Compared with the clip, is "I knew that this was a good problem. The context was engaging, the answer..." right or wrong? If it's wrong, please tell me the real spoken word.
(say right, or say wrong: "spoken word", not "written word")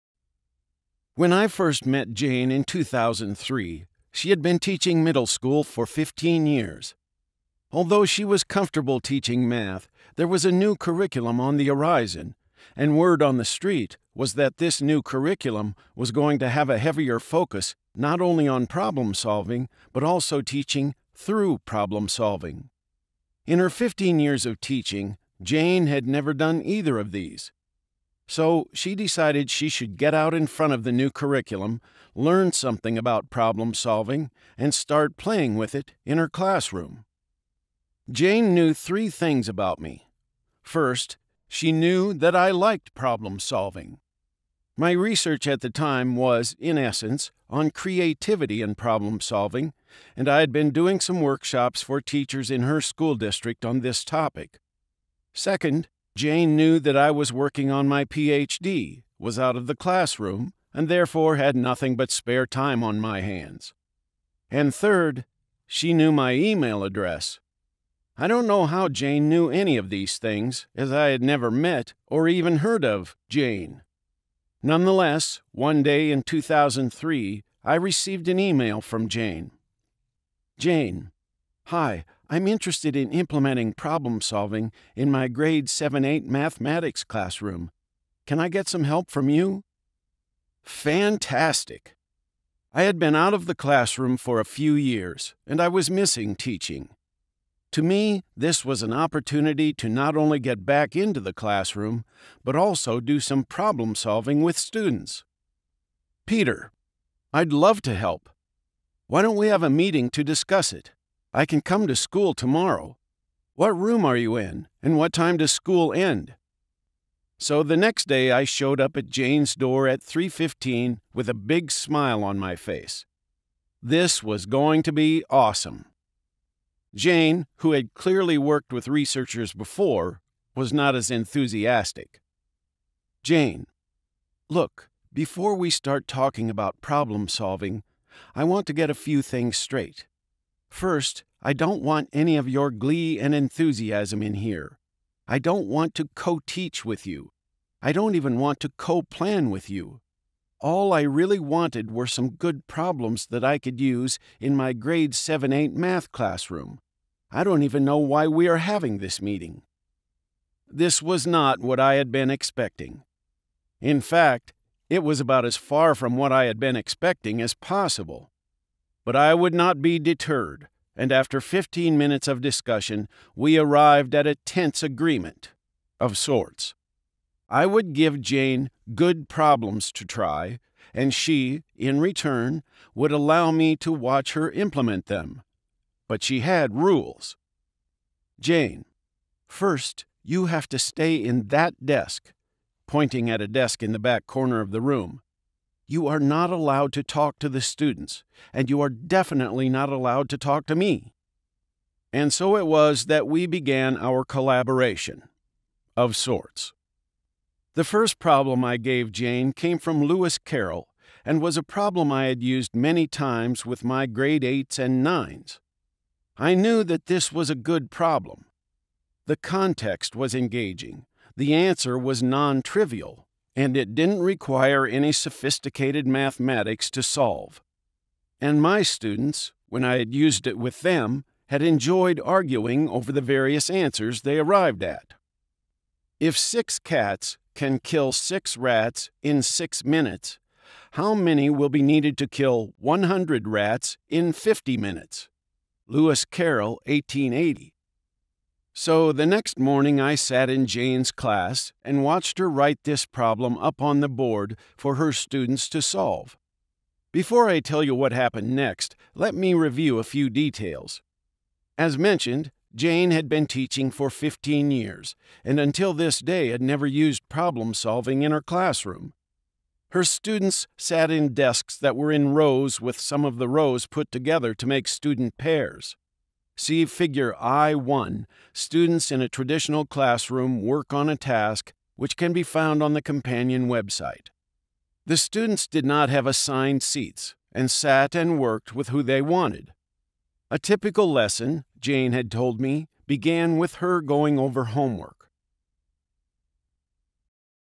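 right.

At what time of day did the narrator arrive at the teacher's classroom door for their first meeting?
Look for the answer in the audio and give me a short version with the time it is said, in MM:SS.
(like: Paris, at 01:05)
3:15, at 02:00.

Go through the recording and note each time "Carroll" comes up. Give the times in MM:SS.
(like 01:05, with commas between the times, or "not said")
03:30, 04:06.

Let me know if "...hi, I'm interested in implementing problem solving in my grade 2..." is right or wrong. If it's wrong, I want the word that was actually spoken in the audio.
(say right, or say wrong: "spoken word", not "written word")
wrong: "7", not "2".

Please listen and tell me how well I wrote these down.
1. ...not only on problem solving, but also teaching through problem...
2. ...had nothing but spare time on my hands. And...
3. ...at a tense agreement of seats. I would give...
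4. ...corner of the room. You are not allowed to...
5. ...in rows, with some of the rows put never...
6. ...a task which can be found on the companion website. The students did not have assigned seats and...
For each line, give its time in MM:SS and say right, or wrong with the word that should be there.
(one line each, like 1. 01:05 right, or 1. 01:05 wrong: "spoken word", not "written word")
1. 00:17 right
2. 01:01 right
3. 02:54 wrong: "sorts", not "seats"
4. 03:14 right
5. 04:32 wrong: "together", not "never"
6. 04:41 right.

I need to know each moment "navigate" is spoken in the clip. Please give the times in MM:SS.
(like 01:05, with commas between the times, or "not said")
not said.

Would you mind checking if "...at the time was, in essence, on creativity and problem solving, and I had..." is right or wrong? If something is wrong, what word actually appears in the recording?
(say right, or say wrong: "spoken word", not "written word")
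right.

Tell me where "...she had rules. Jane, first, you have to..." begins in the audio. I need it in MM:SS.
03:06.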